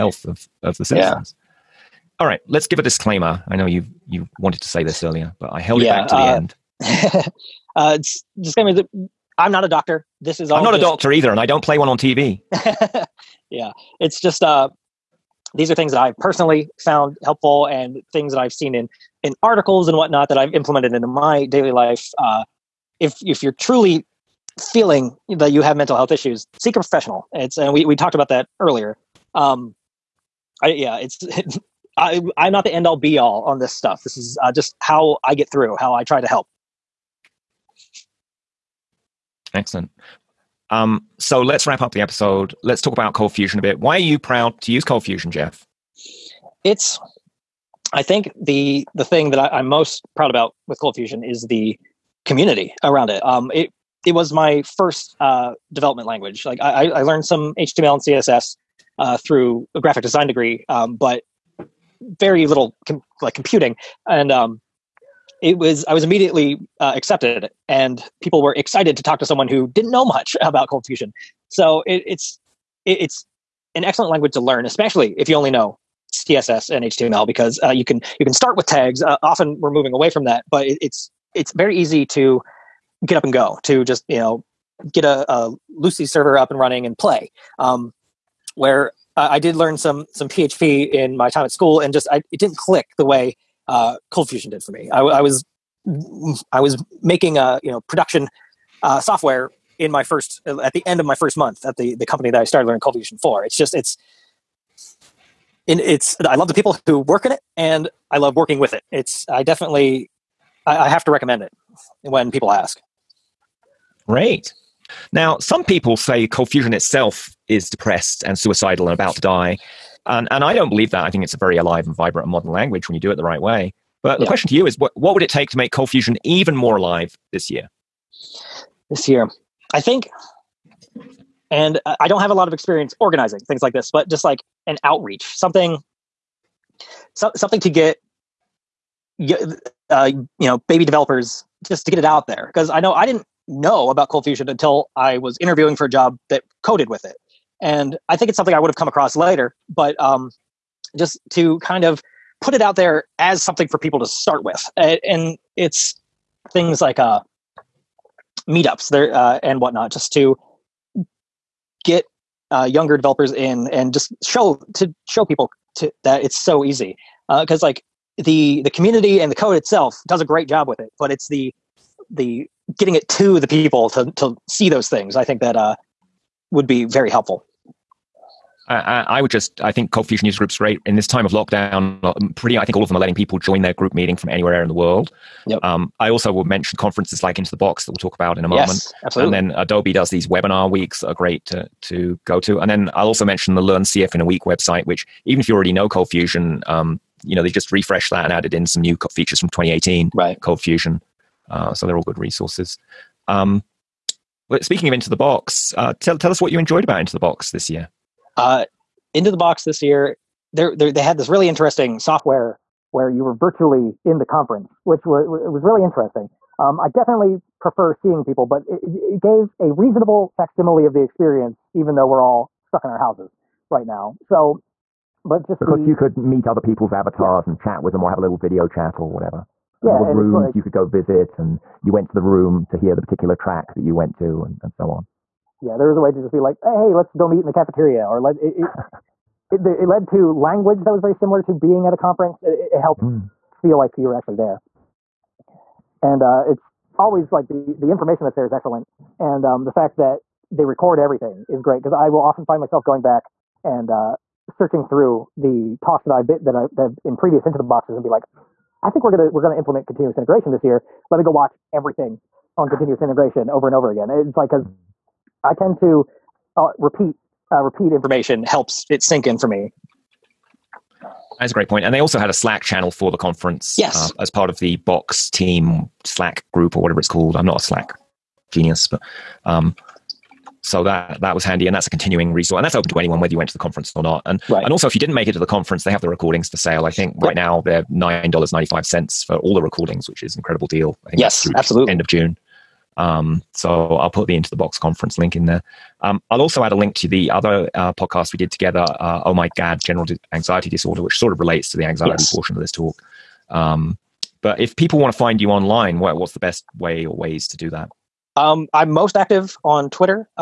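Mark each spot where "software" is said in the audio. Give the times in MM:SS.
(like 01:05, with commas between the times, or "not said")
01:38, 03:31.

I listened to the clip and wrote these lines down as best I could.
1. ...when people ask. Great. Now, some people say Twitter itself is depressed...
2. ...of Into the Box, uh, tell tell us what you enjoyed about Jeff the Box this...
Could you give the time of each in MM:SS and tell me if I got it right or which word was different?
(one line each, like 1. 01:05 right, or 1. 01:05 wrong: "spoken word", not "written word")
1. 01:52 wrong: "Fusion", not "Twitter"
2. 03:24 wrong: "Into", not "Jeff".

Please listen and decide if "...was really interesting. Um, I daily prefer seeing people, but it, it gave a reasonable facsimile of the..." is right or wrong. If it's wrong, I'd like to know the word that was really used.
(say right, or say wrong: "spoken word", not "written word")
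wrong: "definitely", not "daily".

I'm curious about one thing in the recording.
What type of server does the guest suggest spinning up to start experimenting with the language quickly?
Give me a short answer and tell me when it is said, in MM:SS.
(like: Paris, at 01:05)
Lucee, at 01:25.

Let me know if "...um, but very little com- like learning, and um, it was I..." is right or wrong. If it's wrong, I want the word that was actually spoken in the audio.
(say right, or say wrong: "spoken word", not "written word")
wrong: "computing", not "learning".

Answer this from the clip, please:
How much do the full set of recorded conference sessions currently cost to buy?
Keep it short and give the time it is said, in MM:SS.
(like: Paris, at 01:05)
$9.95, at 04:47.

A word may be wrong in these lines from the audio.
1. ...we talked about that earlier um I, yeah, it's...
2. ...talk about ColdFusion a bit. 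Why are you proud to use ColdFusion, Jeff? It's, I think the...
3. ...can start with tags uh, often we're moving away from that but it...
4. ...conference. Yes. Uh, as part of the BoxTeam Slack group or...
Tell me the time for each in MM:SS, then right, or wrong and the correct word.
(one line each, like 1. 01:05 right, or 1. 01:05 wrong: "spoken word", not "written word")
1. 00:27 right
2. 00:42 right
3. 01:18 right
4. 04:33 right.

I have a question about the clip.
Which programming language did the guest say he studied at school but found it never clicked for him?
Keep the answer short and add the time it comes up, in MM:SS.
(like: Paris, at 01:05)
PHP, at 01:30.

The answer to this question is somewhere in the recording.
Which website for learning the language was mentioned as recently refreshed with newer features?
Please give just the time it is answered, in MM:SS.
03:13.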